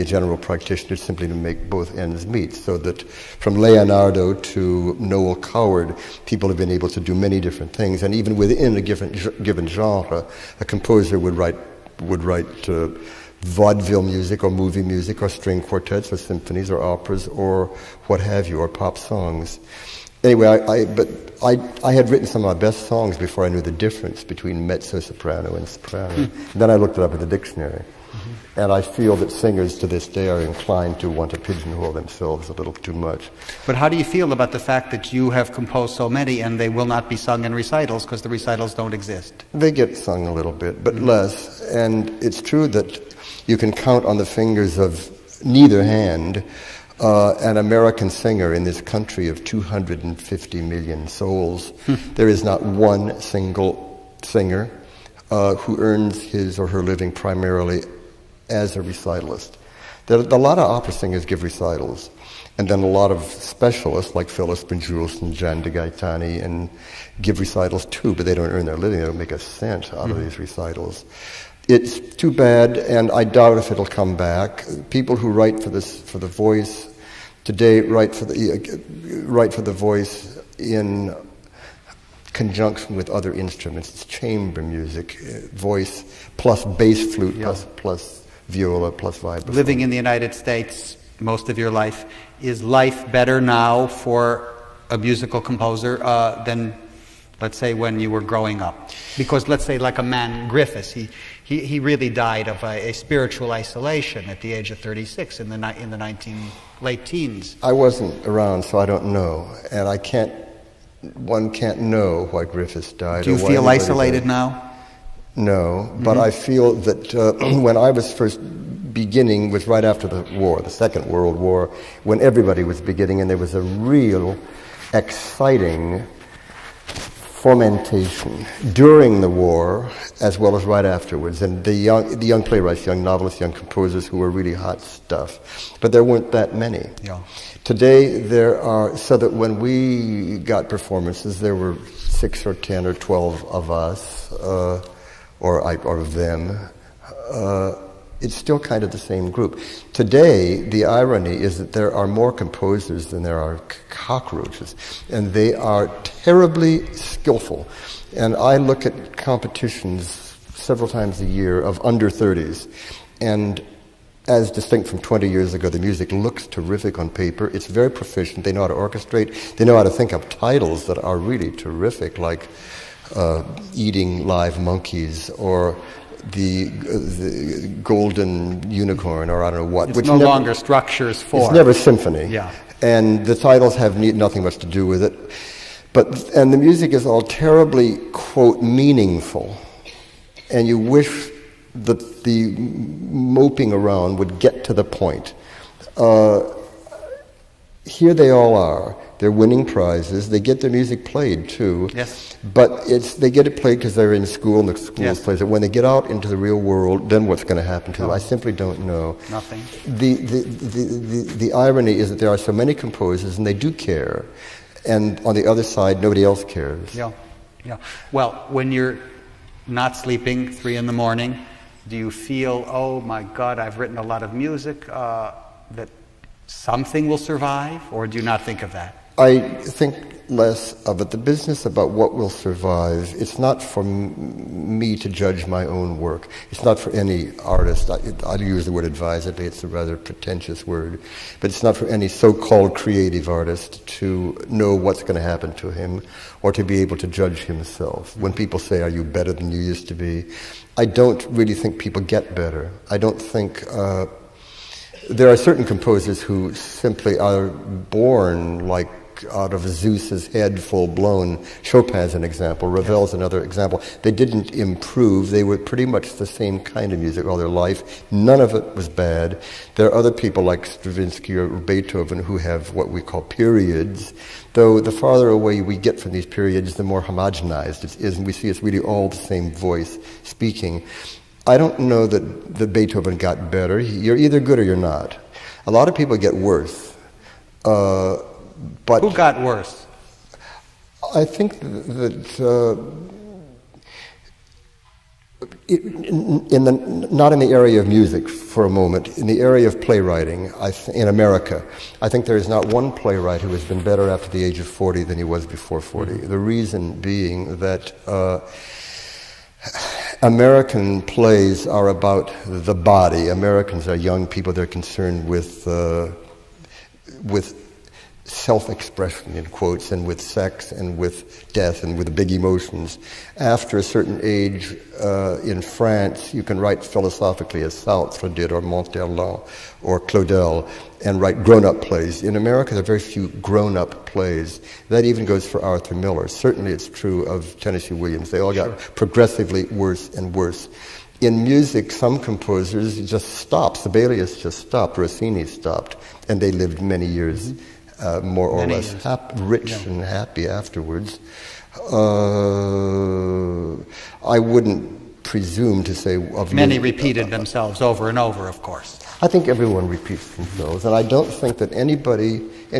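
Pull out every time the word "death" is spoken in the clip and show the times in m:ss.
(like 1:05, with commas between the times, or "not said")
5:21.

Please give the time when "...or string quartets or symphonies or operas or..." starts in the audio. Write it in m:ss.
0:15.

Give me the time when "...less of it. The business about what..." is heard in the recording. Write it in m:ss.
3:50.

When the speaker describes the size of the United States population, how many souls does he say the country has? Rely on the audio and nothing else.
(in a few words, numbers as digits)
250 million.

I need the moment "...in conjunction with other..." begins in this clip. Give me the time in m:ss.
1:20.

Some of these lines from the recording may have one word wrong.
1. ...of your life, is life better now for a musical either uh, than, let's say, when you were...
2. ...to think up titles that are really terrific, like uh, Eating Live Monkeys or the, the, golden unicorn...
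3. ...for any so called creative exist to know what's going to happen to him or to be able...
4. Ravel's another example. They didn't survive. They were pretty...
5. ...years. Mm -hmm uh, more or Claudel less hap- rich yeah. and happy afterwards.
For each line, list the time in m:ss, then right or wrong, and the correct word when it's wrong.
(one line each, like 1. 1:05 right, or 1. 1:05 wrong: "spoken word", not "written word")
1. 1:31 wrong: "composer", not "either"
2. 2:49 right
3. 4:01 wrong: "artist", not "exist"
4. 4:22 wrong: "improve", not "survive"
5. 5:47 wrong: "Many", not "Claudel".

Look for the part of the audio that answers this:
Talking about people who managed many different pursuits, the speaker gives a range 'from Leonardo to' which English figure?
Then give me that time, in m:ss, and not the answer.
0:04.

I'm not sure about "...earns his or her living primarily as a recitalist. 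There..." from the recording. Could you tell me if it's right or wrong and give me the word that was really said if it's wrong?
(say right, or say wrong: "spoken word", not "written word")
right.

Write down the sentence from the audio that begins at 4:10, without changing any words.
I don't really think people get better.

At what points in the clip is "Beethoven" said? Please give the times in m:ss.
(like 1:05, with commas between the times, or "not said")
4:31, 4:42.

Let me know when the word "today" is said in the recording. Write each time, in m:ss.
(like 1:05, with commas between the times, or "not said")
1:17, 2:17, 2:29.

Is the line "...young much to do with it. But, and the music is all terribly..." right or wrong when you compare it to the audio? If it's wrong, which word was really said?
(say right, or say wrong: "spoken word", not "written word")
wrong: "nothing", not "young".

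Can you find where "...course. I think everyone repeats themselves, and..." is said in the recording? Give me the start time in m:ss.
5:58.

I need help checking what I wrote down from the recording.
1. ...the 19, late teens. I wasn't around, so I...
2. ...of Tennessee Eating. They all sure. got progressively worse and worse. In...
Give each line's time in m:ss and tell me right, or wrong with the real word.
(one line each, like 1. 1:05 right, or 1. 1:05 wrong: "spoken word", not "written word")
1. 1:45 right
2. 5:37 wrong: "Williams", not "Eating".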